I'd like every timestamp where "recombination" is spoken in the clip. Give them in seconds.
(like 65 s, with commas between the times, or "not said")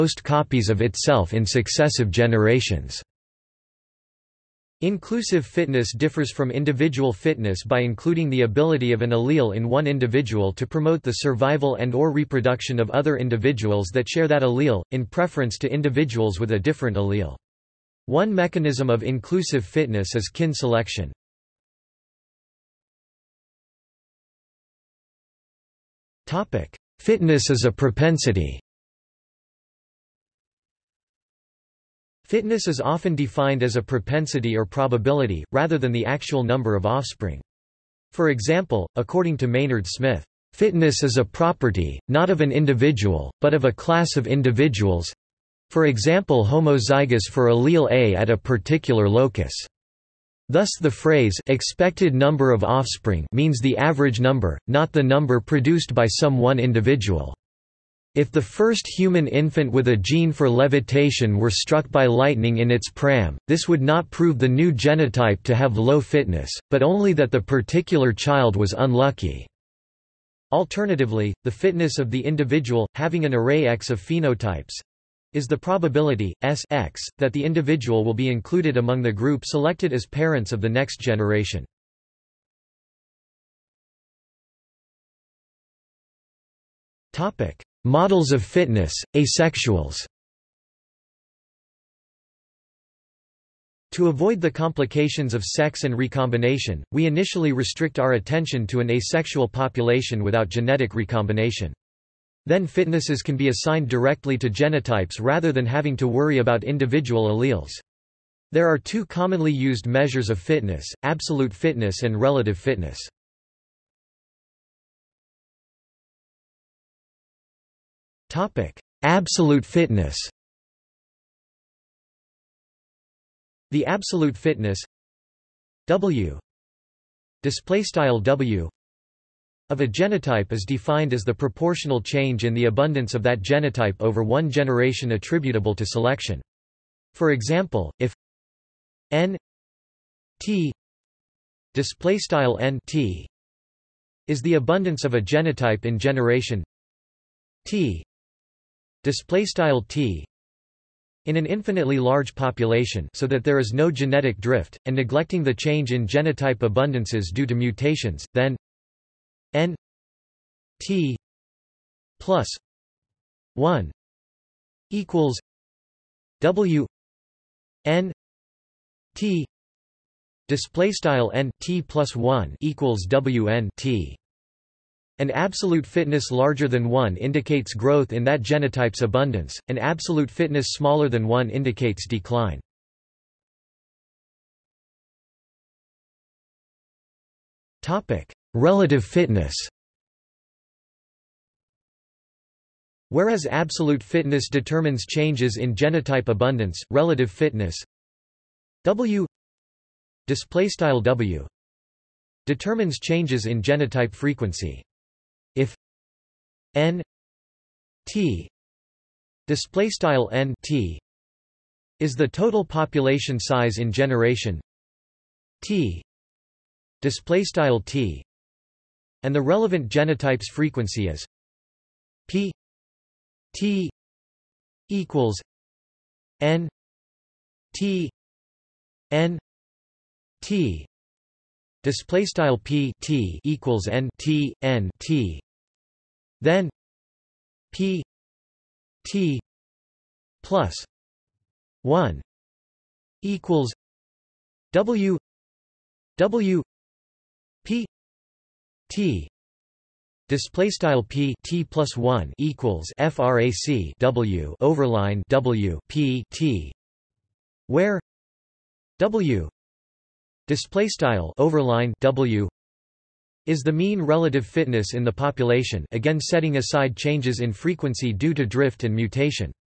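95 s, 100 s.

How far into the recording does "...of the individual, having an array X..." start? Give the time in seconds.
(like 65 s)
71 s.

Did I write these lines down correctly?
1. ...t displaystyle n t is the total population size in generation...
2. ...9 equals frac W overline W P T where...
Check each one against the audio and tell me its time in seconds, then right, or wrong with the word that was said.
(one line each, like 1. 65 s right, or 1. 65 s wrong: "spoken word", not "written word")
1. 208 s right
2. 251 s wrong: "1", not "9".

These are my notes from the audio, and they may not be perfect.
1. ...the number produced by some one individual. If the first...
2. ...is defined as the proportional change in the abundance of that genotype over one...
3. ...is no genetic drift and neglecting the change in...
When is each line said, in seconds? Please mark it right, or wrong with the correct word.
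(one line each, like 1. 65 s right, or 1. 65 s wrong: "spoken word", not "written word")
1. 54 s right
2. 130 s right
3. 153 s right.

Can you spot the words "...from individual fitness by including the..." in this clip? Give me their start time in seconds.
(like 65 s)
6 s.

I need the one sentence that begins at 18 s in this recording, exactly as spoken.
One mechanism of inclusive fitness is kin selection.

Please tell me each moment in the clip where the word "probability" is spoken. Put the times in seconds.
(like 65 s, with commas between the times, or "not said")
34 s, 75 s.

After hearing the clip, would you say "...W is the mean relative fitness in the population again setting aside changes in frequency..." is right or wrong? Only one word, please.
right.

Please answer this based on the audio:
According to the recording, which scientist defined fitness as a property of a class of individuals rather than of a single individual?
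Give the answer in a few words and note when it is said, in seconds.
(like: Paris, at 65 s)
Maynard Smith, at 39 s.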